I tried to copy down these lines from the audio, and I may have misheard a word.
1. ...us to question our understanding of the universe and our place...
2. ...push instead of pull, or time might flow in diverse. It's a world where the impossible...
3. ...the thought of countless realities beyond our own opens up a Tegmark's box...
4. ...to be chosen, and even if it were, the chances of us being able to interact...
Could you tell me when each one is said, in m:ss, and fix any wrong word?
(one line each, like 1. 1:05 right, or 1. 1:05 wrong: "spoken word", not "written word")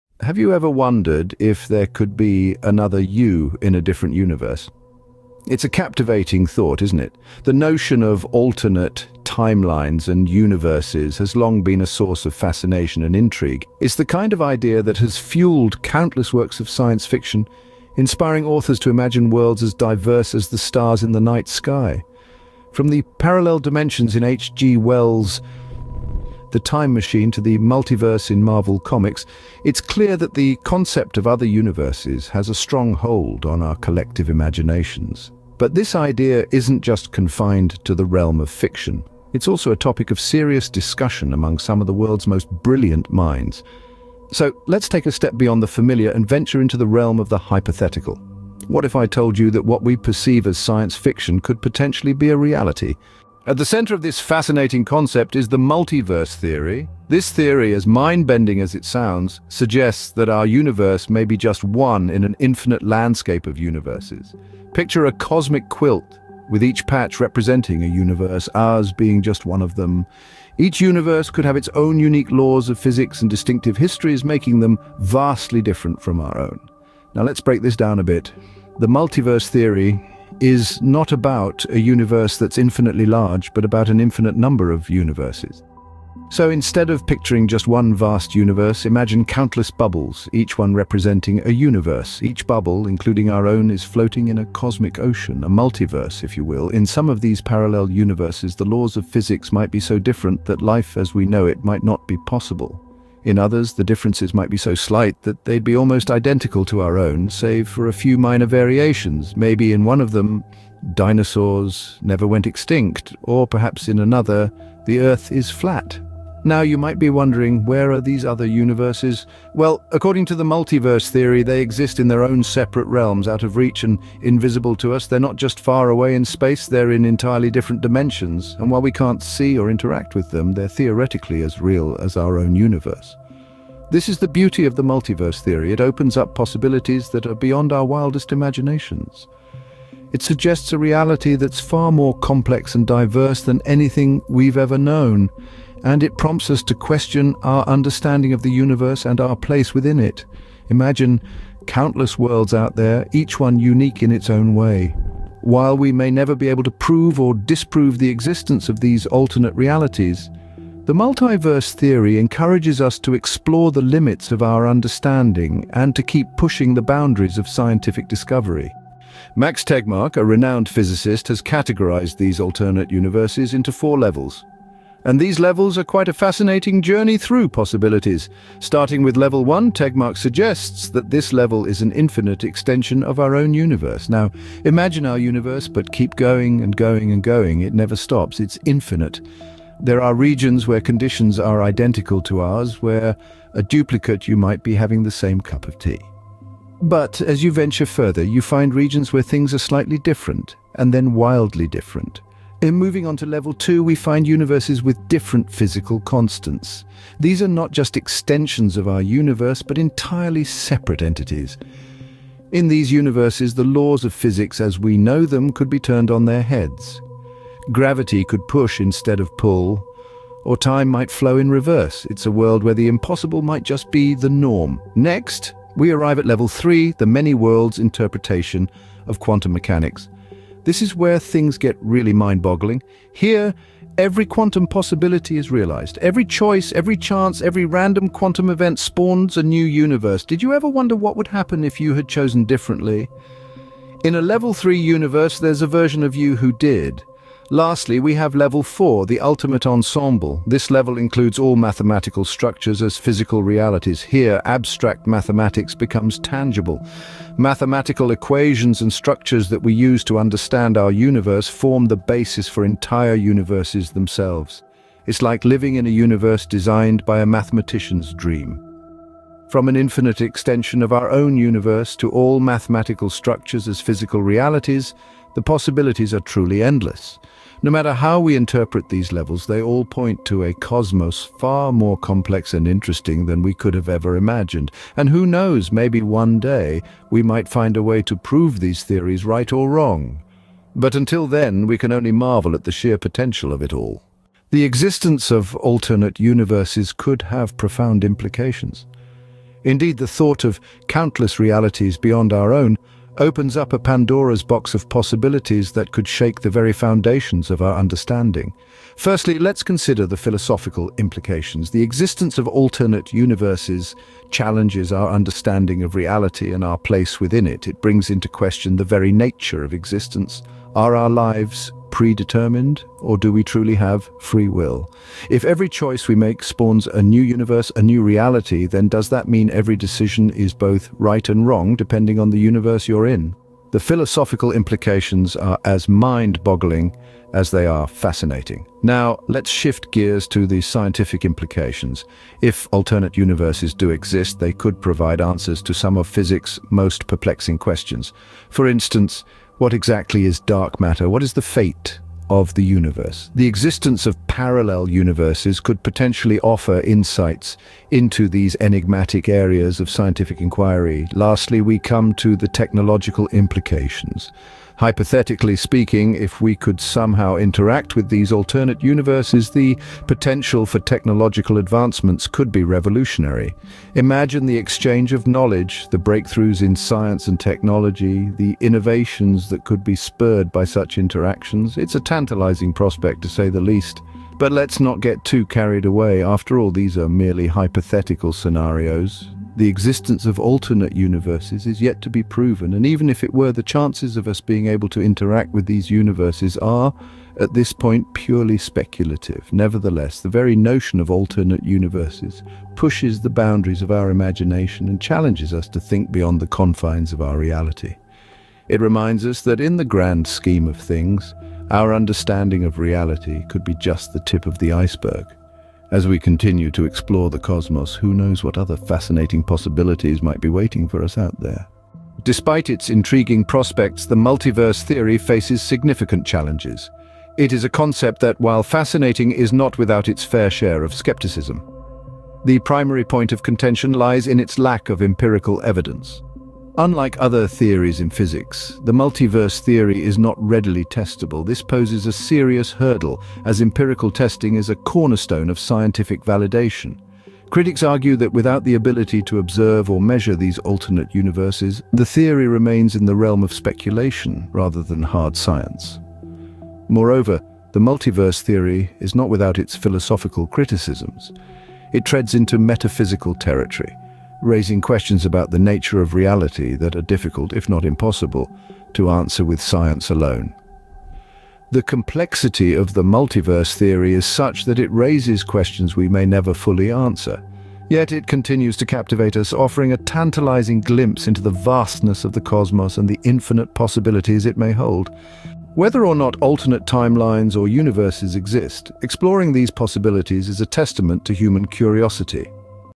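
1. 2:26 right
2. 3:38 wrong: "reverse", not "diverse"
3. 4:59 wrong: "Pandora", not "Tegmark"
4. 6:32 wrong: "proven", not "chosen".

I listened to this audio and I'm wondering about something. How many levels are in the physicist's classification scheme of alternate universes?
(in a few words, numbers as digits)
4.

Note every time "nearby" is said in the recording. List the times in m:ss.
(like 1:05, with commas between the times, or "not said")
not said.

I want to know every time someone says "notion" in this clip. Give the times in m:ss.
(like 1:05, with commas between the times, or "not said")
0:07, 6:40.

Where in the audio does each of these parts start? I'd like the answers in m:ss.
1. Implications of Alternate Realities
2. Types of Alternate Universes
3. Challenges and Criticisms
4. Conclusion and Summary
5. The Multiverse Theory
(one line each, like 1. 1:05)
1. 4:54
2. 2:48
3. 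7:01
4. 8:05
5. 0:53.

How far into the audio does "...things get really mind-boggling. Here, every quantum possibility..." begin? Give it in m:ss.
3:51.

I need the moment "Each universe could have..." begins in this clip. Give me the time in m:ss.
1:10.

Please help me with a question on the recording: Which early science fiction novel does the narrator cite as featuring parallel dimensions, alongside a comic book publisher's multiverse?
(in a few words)
The Time Machine.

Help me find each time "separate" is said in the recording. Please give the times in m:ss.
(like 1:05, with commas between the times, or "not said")
2:02, 3:30.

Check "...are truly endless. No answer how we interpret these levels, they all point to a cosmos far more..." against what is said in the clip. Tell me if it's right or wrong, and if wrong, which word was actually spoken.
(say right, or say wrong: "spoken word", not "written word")
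wrong: "matter", not "answer".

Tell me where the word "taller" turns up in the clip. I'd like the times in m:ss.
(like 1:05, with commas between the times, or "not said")
not said.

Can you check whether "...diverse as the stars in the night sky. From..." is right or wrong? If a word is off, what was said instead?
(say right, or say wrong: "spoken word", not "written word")
right.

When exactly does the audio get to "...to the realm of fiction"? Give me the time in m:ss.
0:37.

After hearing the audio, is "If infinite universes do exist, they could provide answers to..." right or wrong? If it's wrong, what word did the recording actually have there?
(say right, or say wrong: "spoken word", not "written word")
wrong: "alternate", not "infinite".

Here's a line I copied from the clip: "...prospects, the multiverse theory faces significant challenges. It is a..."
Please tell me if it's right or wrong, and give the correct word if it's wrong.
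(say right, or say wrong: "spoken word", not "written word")
right.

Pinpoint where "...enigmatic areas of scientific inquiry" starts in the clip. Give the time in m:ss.
5:58.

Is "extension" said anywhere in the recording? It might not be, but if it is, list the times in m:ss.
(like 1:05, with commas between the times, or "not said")
3:02, 3:27, 4:30.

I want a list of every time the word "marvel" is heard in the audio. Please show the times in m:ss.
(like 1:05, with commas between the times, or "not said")
0:28, 4:52.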